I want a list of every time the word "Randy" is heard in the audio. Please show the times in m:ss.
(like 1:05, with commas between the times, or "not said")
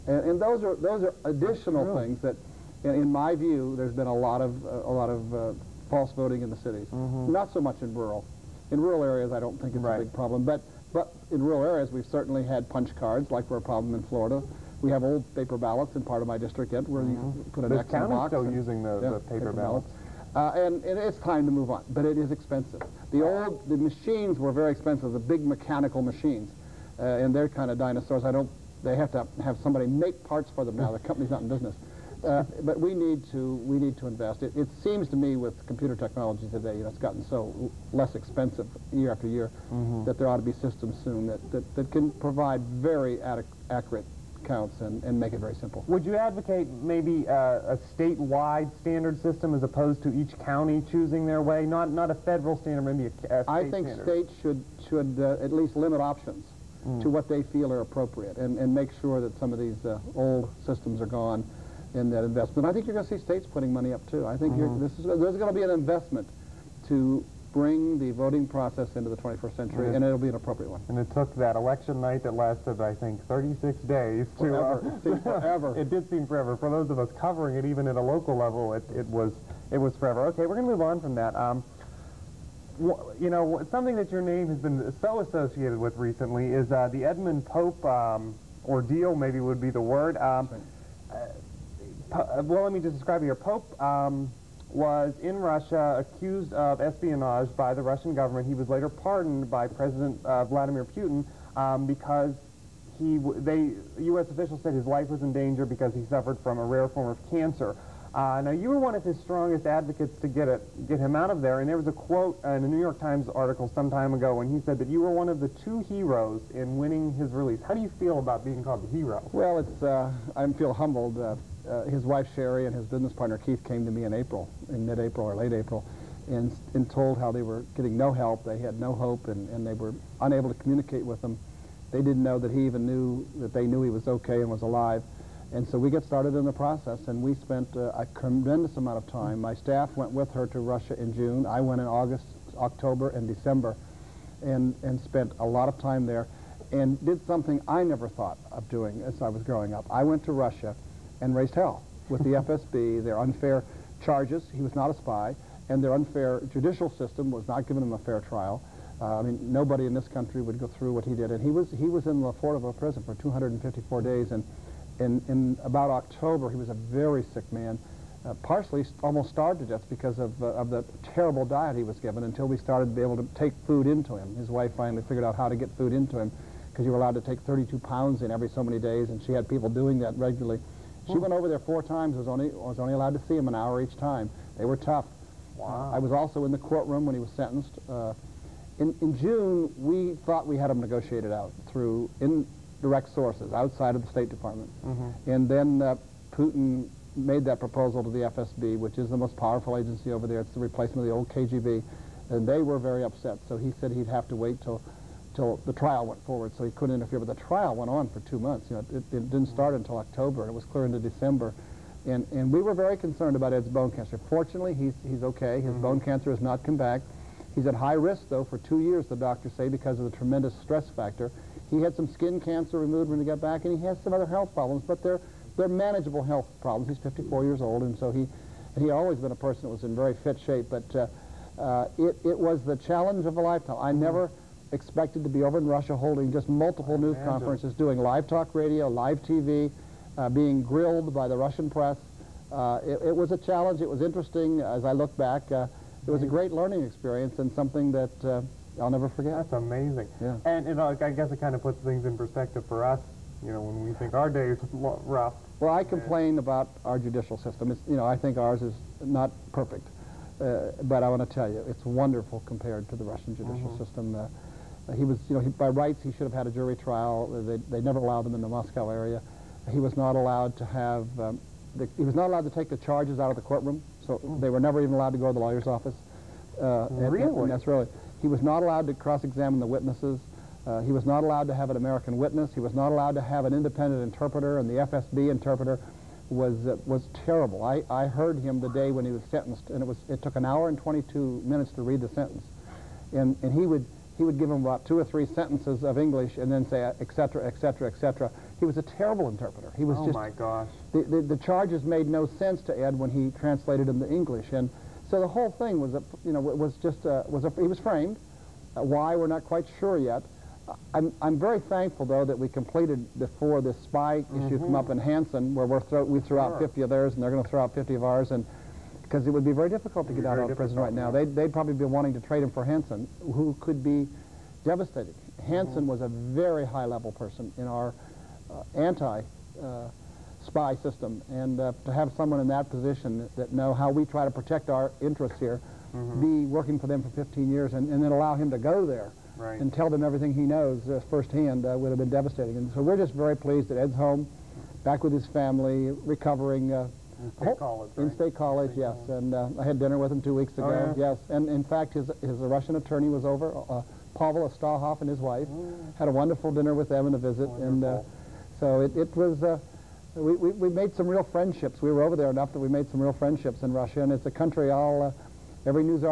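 not said.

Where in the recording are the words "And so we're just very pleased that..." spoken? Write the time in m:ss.
5:42.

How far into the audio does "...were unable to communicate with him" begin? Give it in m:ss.
2:09.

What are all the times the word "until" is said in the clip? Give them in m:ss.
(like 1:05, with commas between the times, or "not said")
2:52, 3:29.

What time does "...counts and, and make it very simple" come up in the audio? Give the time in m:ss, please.
0:44.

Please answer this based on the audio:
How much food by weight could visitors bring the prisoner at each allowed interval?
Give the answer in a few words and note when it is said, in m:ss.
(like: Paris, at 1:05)
32 pounds, at 2:57.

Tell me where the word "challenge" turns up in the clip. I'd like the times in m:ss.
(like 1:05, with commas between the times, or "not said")
3:52, 4:03.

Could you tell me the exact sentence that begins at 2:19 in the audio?
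My staff went with her to Russia in June.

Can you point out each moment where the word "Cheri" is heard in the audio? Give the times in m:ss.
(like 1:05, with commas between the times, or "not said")
2:02.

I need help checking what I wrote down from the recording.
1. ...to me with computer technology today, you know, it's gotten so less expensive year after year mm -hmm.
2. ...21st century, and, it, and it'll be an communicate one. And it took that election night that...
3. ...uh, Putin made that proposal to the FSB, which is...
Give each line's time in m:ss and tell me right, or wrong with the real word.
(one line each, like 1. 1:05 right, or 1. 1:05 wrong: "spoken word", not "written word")
1. 0:35 right
2. 1:09 wrong: "appropriate", not "communicate"
3. 3:15 right.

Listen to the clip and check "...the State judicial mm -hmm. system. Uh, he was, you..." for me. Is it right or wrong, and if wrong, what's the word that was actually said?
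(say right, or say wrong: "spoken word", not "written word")
wrong: "Russian", not "State".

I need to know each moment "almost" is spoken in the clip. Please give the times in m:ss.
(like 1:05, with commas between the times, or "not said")
2:49.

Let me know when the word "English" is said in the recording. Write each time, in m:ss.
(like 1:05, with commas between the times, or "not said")
4:55, 5:04.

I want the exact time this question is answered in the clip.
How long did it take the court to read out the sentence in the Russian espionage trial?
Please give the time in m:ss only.
4:50.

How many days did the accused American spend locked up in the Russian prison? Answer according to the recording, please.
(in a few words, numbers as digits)
254.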